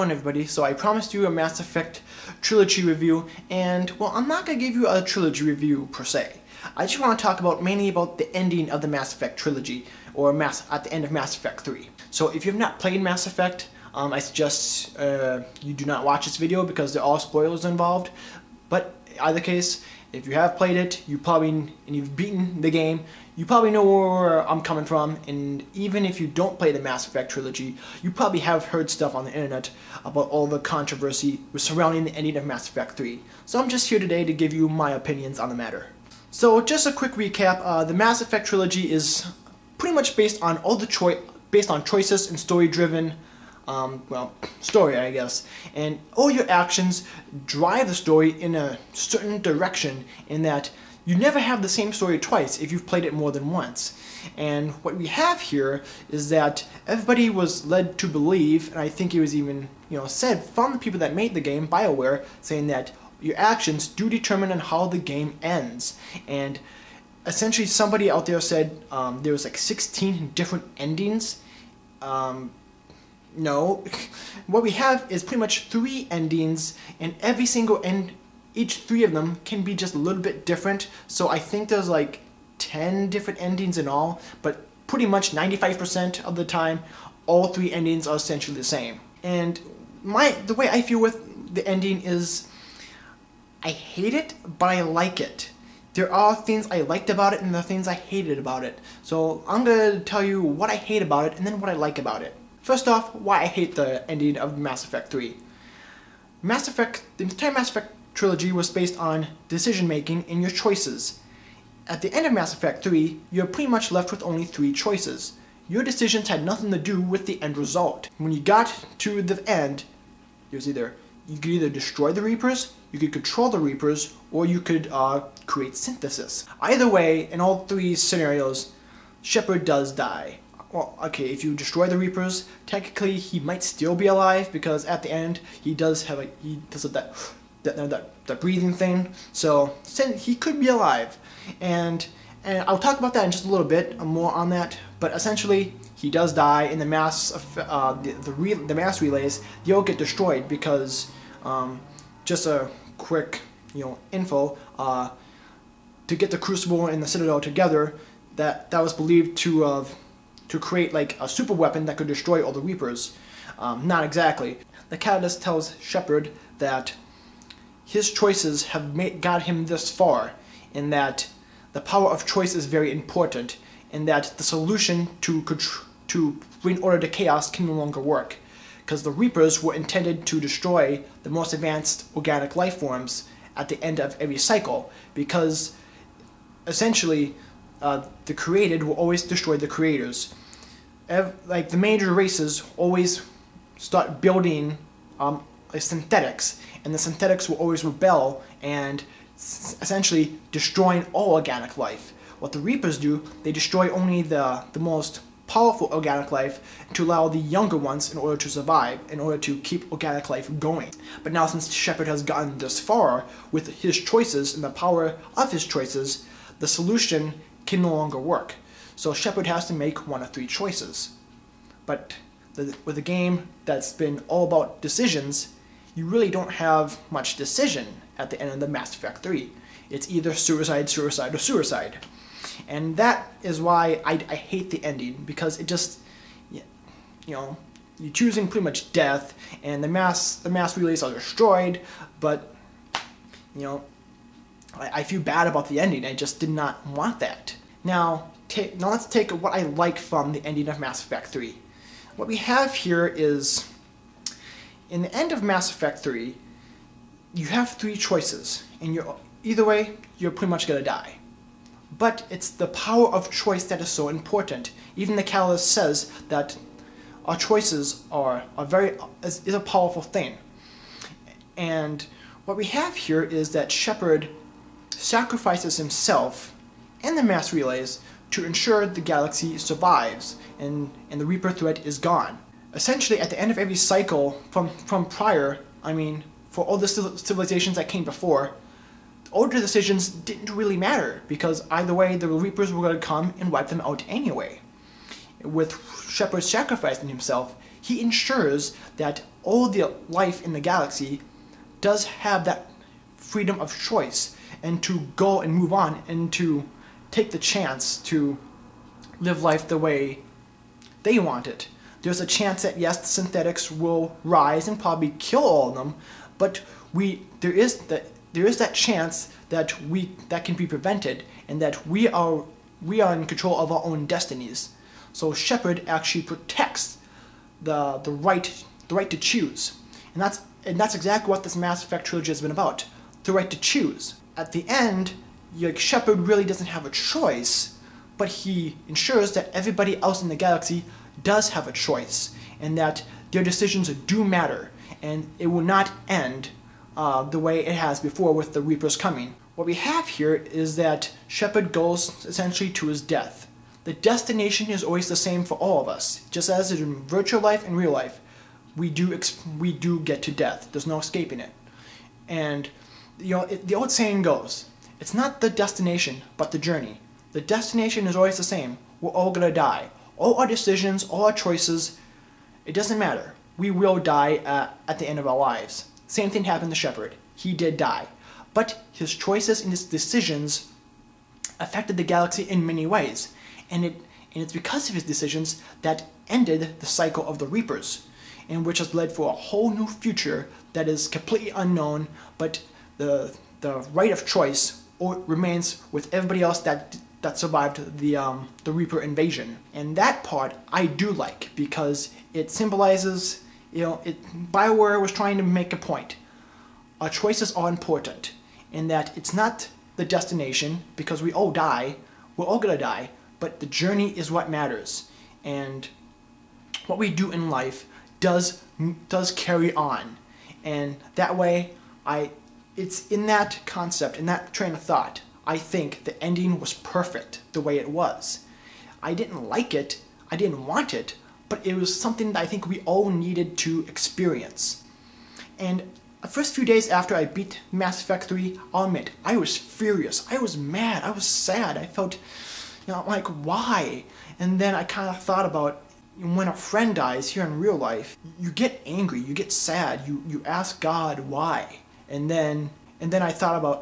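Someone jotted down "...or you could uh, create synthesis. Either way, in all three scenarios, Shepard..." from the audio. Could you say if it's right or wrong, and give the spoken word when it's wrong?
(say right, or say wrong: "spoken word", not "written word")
right.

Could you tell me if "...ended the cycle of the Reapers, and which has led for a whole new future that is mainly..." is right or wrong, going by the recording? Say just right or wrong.
wrong.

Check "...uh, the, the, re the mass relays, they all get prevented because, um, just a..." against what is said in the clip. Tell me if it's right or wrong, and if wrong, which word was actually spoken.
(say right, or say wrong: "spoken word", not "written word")
wrong: "destroyed", not "prevented".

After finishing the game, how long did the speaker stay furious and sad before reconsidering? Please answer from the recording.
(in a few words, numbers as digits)
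first few days.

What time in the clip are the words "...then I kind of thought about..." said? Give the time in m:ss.
7:24.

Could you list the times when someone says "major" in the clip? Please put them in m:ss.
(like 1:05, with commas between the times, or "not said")
3:11.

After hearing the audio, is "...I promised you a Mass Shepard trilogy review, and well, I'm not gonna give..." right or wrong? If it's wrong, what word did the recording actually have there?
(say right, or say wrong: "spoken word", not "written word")
wrong: "Effect", not "Shepard".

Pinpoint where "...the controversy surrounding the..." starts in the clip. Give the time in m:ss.
0:30.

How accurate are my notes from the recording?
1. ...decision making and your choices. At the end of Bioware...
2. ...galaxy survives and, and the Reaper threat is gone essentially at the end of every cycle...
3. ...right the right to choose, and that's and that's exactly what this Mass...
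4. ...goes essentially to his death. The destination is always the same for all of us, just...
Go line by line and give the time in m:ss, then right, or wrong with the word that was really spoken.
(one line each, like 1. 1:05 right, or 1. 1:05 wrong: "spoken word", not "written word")
1. 1:49 wrong: "Mass", not "Bioware"
2. 4:39 right
3. 5:28 right
4. 5:51 right.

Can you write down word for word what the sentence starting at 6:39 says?
And that part I do like because it symbolizes, you know, it, Bioware was trying to make a point.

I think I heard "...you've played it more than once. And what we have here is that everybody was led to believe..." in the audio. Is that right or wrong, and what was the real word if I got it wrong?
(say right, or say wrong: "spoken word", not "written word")
right.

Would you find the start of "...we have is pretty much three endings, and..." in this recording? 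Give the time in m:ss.
1:14.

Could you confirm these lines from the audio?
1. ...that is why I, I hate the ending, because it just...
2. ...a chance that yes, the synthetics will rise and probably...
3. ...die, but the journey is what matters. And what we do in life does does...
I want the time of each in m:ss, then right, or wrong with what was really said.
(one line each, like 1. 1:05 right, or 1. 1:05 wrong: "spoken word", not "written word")
1. 3:52 right
2. 5:12 right
3. 6:52 right.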